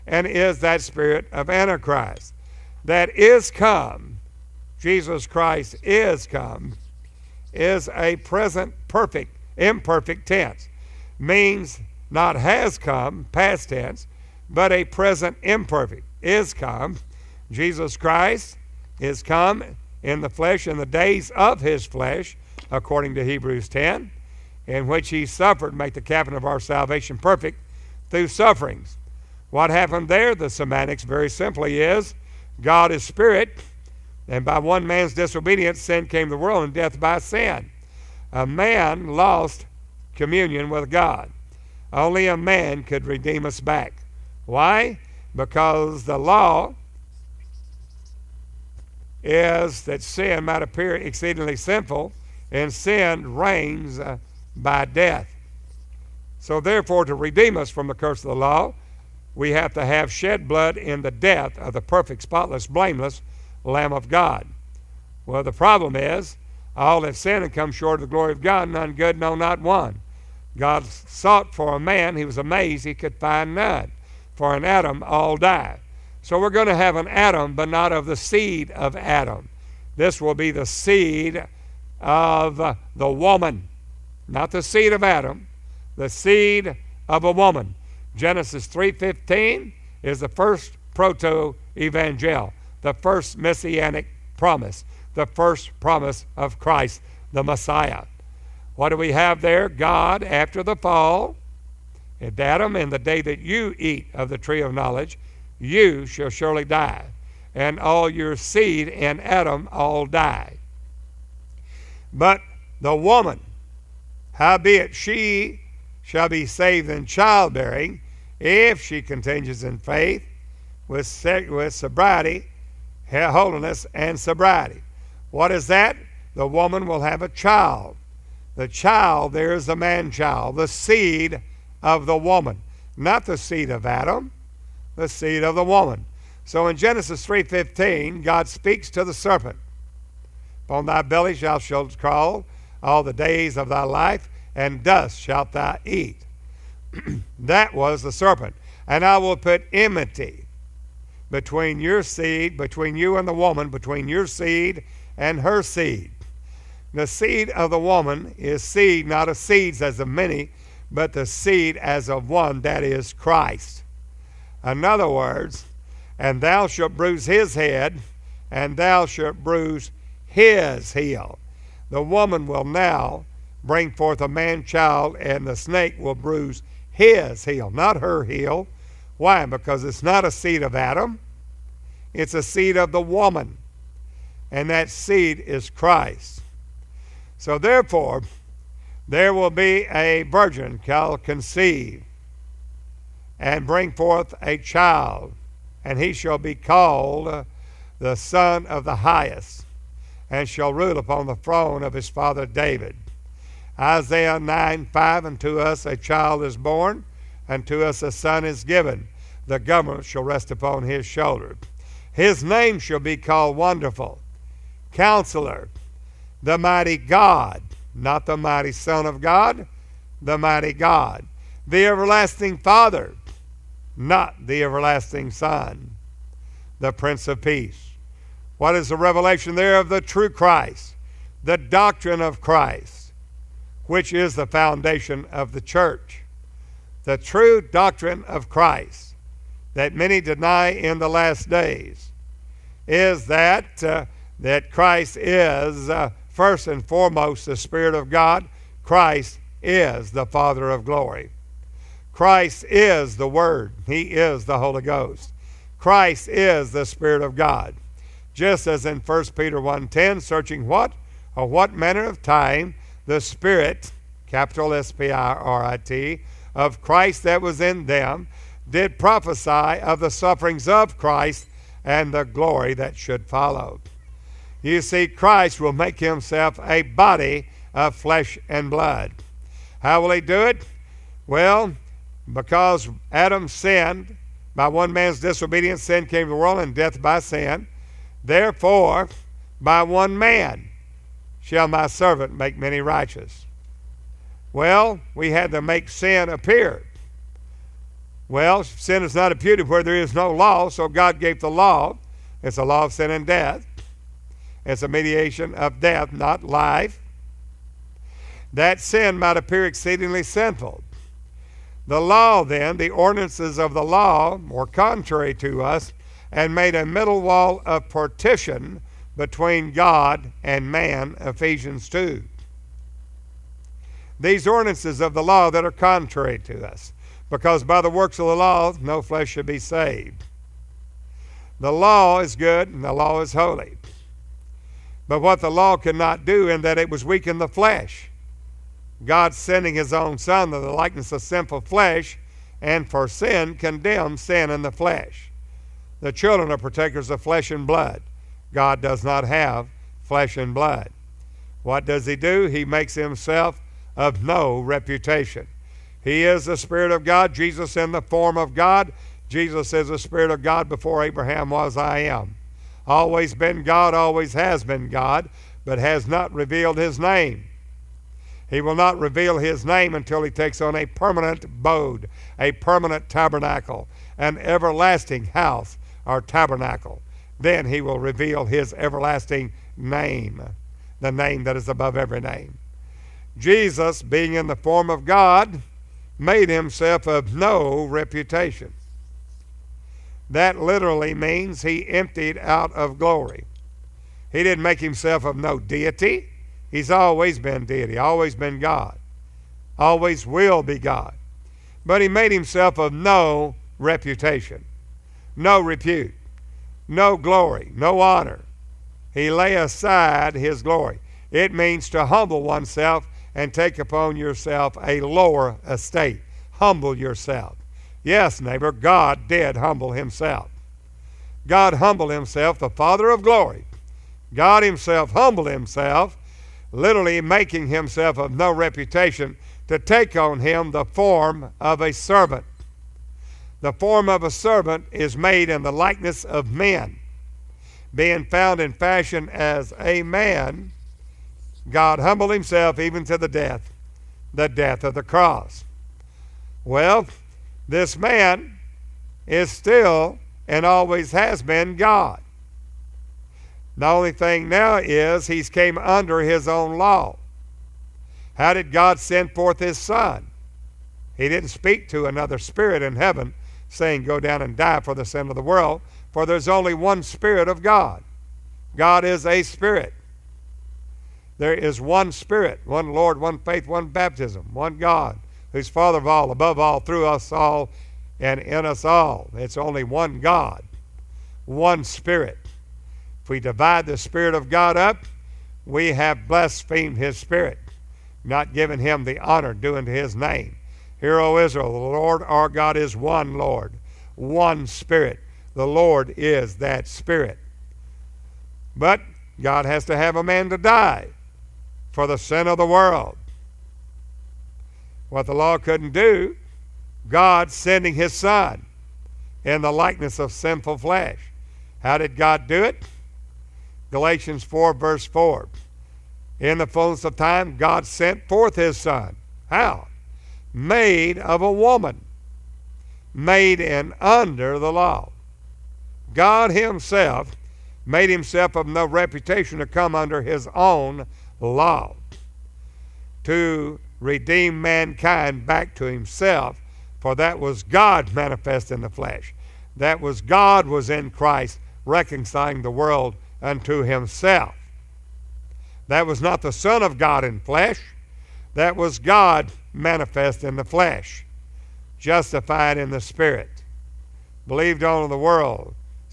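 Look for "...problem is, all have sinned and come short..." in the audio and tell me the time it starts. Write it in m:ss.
1:05.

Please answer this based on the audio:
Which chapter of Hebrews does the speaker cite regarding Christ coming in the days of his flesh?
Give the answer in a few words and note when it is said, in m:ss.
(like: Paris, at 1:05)
10, at 0:23.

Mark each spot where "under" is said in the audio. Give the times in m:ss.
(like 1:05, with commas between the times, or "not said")
7:35, 8:44, 8:49.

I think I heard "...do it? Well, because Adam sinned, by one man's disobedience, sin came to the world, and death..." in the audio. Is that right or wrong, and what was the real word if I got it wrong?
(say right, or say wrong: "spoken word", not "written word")
right.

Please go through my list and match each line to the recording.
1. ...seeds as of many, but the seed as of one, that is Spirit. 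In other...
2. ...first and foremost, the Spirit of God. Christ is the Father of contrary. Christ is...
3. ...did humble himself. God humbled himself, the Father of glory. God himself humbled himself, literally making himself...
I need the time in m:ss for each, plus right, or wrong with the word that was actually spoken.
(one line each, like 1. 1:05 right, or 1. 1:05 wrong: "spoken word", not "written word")
1. 2:39 wrong: "Christ", not "Spirit"
2. 4:06 wrong: "glory", not "contrary"
3. 6:59 right.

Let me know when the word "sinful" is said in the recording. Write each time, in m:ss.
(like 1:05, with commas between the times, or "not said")
0:51, 5:10, 5:41, 8:30.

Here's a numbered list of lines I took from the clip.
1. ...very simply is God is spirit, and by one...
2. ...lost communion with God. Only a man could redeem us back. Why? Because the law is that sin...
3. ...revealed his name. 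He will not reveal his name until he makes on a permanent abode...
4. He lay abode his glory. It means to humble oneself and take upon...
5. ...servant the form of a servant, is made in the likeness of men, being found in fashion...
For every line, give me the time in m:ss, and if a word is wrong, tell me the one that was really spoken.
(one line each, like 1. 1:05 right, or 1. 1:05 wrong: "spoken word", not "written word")
1. 0:31 right
2. 0:39 right
3. 6:06 wrong: "takes", not "makes"
4. 6:49 wrong: "aside", not "abode"
5. 7:11 right.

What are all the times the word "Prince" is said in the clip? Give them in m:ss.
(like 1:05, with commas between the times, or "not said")
3:46.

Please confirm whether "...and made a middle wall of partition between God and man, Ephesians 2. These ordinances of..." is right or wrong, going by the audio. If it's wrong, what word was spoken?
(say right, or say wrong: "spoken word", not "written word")
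right.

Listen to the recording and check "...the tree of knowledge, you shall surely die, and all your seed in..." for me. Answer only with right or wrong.
right.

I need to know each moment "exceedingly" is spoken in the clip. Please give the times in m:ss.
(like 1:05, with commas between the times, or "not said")
0:50, 5:09.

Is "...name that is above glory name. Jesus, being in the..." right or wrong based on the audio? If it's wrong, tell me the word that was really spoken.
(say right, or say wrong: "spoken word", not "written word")
wrong: "every", not "glory".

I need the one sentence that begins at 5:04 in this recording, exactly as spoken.
It's a mediation of death, not life.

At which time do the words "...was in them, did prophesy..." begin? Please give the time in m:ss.
4:27.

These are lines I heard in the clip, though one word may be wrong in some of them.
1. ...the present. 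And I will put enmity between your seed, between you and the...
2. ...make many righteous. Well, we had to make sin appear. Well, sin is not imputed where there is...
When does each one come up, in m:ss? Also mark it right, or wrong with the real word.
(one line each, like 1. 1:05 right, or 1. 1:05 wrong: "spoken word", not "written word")
1. 2:28 wrong: "serpent", not "present"
2. 4:52 right.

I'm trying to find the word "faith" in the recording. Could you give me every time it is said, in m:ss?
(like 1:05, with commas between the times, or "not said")
1:59, 7:53.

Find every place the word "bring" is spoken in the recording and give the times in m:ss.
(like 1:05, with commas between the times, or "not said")
2:53, 3:13.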